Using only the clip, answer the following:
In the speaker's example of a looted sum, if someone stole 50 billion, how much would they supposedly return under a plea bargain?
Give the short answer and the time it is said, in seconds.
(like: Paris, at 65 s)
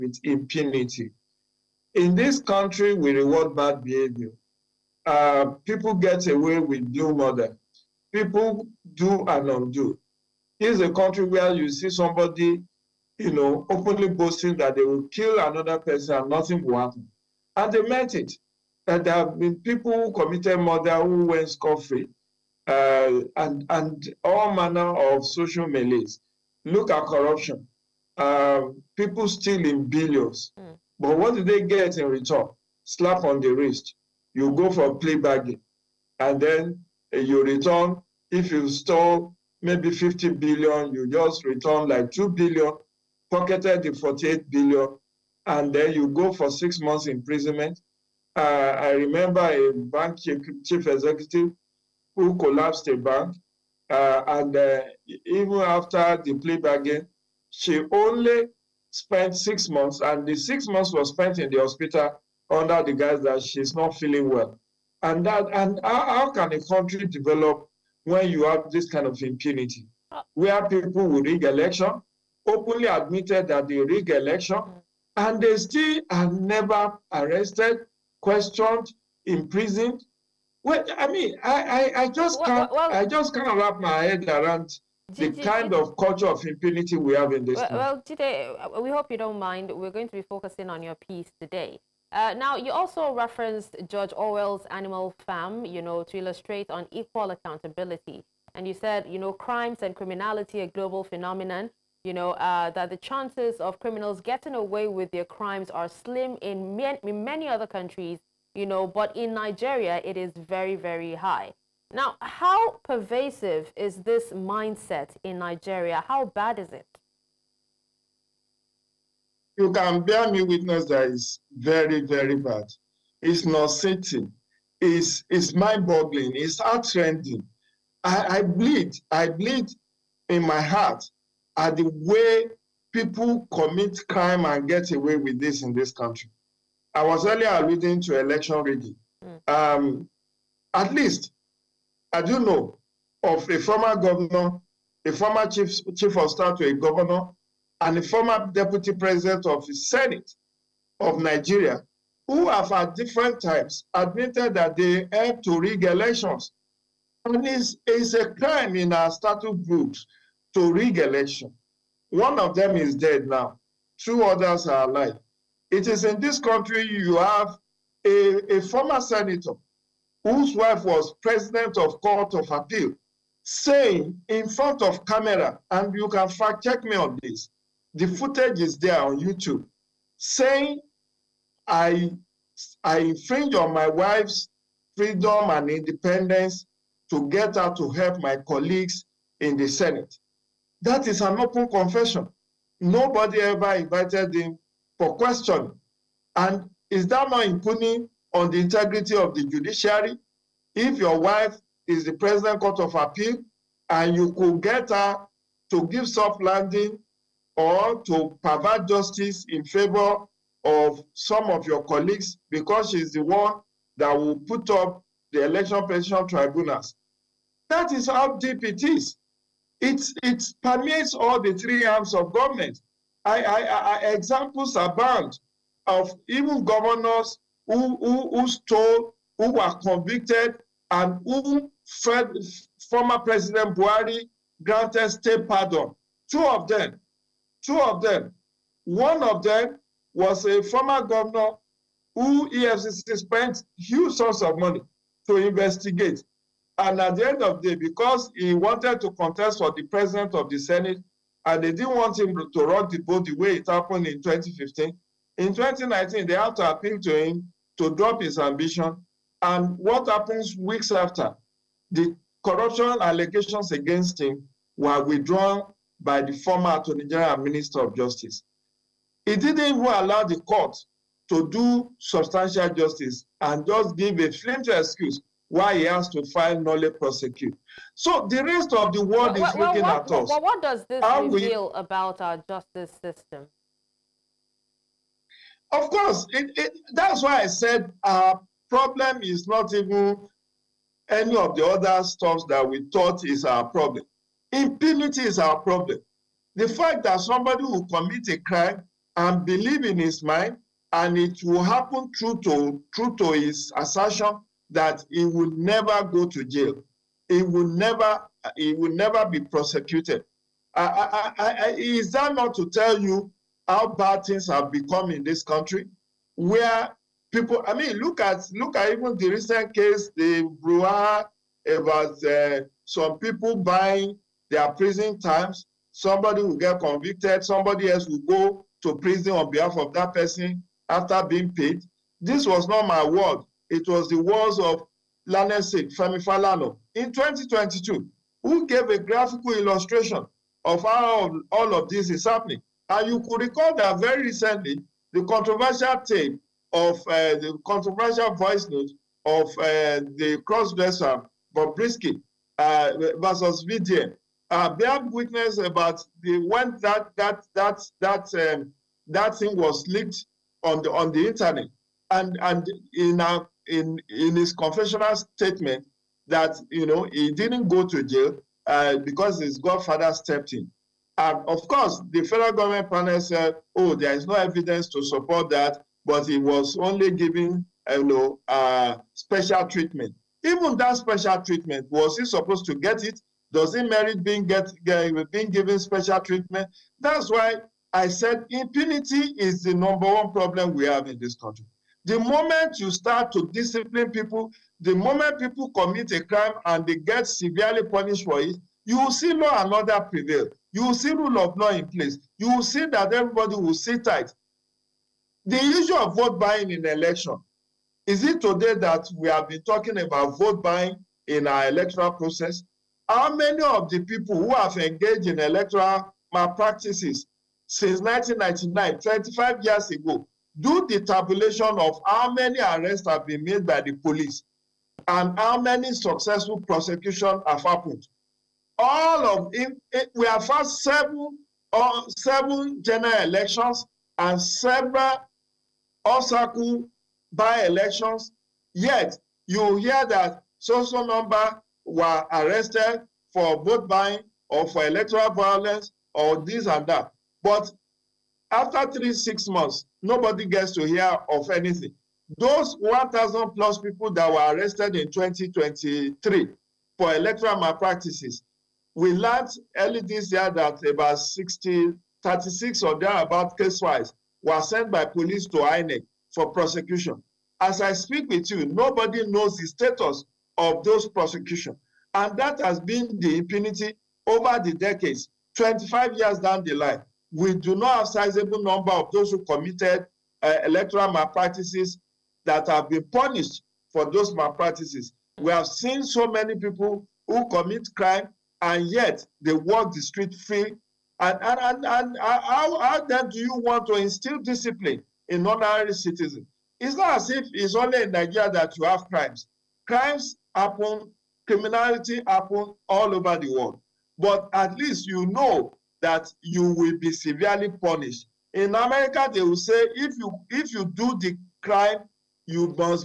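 2 billion, at 42 s.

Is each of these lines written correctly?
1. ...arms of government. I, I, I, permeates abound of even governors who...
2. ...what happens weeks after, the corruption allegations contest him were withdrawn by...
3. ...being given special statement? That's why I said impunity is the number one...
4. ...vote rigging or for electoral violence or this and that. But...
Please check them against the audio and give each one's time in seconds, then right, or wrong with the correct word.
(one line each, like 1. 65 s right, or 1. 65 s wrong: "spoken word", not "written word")
1. 221 s wrong: "examples", not "permeates"
2. 259 s wrong: "against", not "contest"
3. 385 s wrong: "treatment", not "statement"
4. 443 s wrong: "buying", not "rigging".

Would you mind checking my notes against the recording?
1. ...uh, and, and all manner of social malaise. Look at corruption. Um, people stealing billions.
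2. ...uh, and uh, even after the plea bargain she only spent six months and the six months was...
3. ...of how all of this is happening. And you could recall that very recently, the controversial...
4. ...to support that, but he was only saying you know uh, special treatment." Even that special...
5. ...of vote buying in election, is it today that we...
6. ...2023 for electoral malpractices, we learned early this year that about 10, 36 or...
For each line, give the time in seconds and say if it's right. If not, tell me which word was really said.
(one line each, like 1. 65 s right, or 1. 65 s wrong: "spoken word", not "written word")
1. 22 s right
2. 53 s right
3. 340 s right
4. 374 s wrong: "giving", not "saying"
5. 405 s right
6. 455 s wrong: "60", not "10".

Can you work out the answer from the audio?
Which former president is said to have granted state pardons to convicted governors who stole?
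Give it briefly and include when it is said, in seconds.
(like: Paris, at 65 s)
Buhari, at 233 s.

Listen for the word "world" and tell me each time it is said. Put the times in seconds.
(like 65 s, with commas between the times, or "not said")
279 s, 503 s.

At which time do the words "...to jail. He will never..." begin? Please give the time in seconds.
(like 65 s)
306 s.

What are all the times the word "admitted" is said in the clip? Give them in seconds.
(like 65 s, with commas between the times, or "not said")
72 s, 153 s.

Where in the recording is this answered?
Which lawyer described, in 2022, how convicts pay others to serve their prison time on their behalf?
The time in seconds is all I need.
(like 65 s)
335 s.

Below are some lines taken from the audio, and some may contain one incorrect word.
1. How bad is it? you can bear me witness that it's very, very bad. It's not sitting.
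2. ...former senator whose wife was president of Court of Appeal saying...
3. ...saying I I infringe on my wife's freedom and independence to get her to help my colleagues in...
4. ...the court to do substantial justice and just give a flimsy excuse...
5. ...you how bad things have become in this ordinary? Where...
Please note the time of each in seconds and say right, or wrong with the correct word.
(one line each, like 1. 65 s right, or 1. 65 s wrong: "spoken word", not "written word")
1. 116 s right
2. 168 s right
3. 180 s right
4. 270 s right
5. 312 s wrong: "country", not "ordinary".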